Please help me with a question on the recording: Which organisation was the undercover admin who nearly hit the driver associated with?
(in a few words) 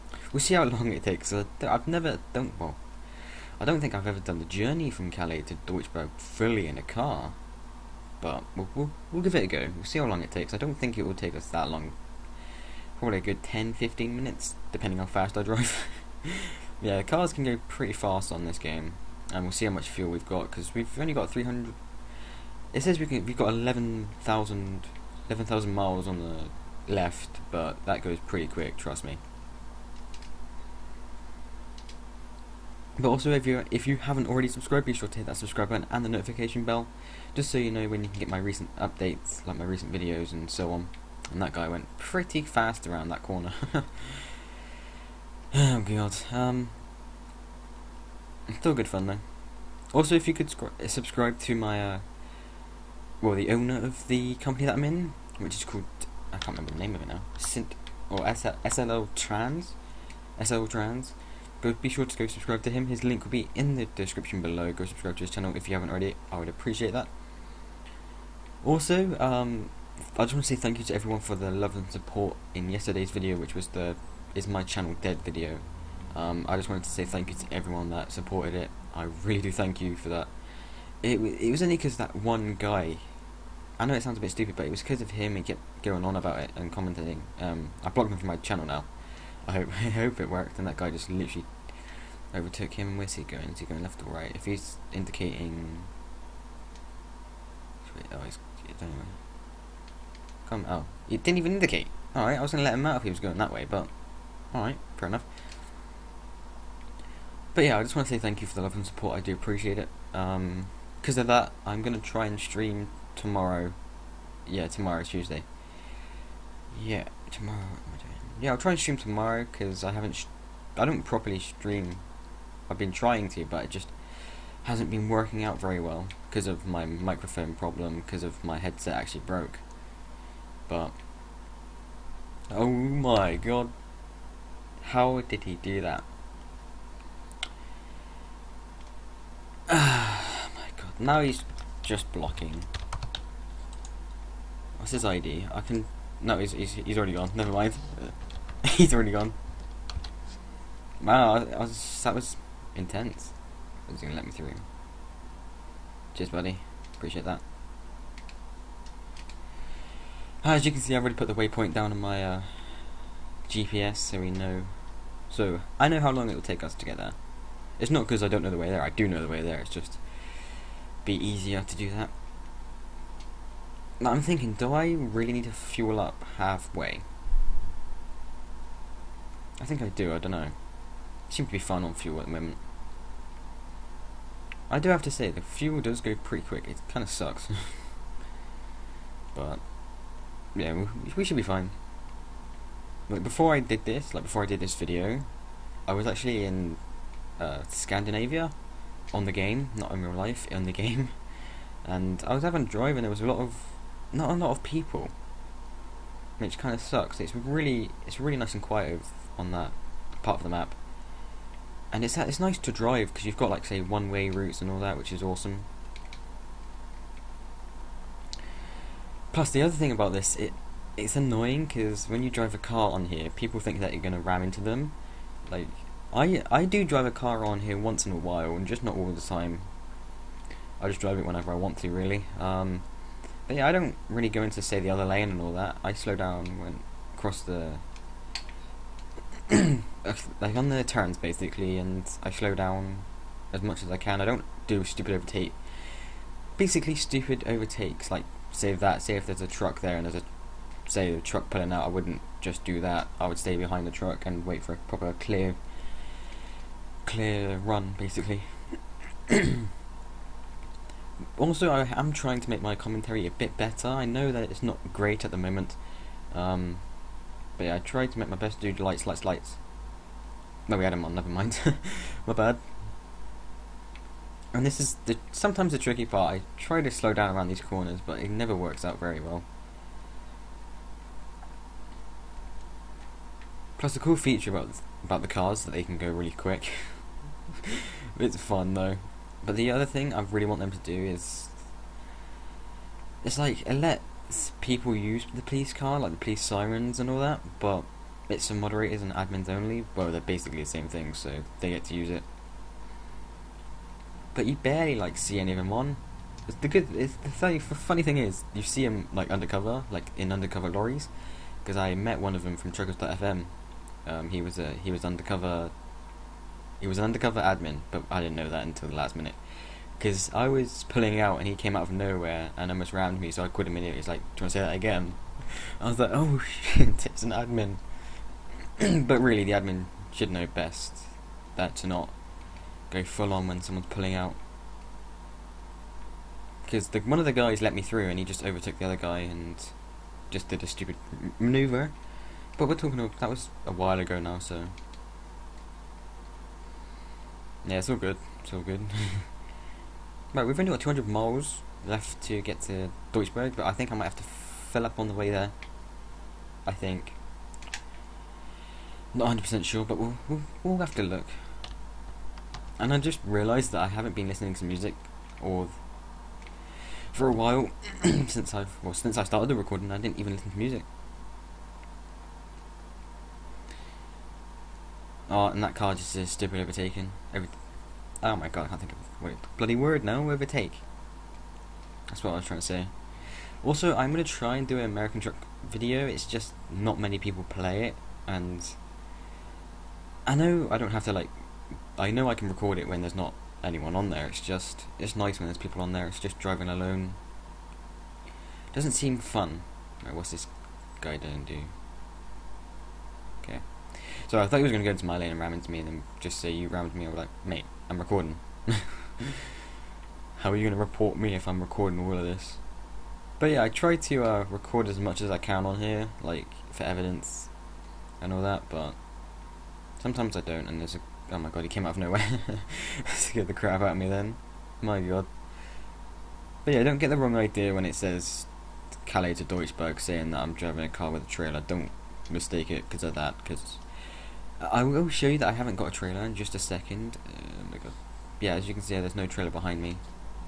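Truckers.fm.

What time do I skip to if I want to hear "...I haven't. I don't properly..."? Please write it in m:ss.
1:59.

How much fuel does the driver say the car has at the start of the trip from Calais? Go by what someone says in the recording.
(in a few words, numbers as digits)
300.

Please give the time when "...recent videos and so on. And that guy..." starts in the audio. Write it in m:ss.
0:39.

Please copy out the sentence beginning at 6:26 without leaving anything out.
It's just not many people play it, and I know I don't have to like.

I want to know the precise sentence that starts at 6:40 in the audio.
Right, what's this guy doing do?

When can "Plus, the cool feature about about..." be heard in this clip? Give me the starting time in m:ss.
4:43.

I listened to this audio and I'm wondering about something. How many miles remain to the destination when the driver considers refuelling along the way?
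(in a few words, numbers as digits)
200.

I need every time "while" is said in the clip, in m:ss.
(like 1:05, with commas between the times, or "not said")
3:48, 5:43, 6:07.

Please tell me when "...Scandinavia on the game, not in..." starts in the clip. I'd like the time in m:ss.
3:17.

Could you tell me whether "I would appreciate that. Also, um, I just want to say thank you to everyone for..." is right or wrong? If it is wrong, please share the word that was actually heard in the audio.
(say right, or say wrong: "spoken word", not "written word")
right.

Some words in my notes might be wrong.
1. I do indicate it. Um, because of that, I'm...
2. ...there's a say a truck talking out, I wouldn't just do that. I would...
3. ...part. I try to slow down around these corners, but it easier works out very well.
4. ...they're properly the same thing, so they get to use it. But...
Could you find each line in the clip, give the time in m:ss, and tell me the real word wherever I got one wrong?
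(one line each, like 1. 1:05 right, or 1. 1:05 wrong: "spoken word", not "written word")
1. 1:49 wrong: "appreciate", not "indicate"
2. 4:10 wrong: "pulling", not "talking"
3. 4:36 wrong: "never", not "easier"
4. 5:00 wrong: "basically", not "properly".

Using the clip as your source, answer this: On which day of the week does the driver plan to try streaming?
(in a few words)
Tuesday.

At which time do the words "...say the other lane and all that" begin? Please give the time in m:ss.
3:54.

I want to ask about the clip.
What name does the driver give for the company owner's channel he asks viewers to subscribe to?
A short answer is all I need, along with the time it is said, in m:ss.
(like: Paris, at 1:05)
SL Trans, at 1:00.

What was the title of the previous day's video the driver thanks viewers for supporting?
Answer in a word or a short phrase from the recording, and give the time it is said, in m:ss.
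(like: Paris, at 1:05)
Is My Channel Dead, at 1:14.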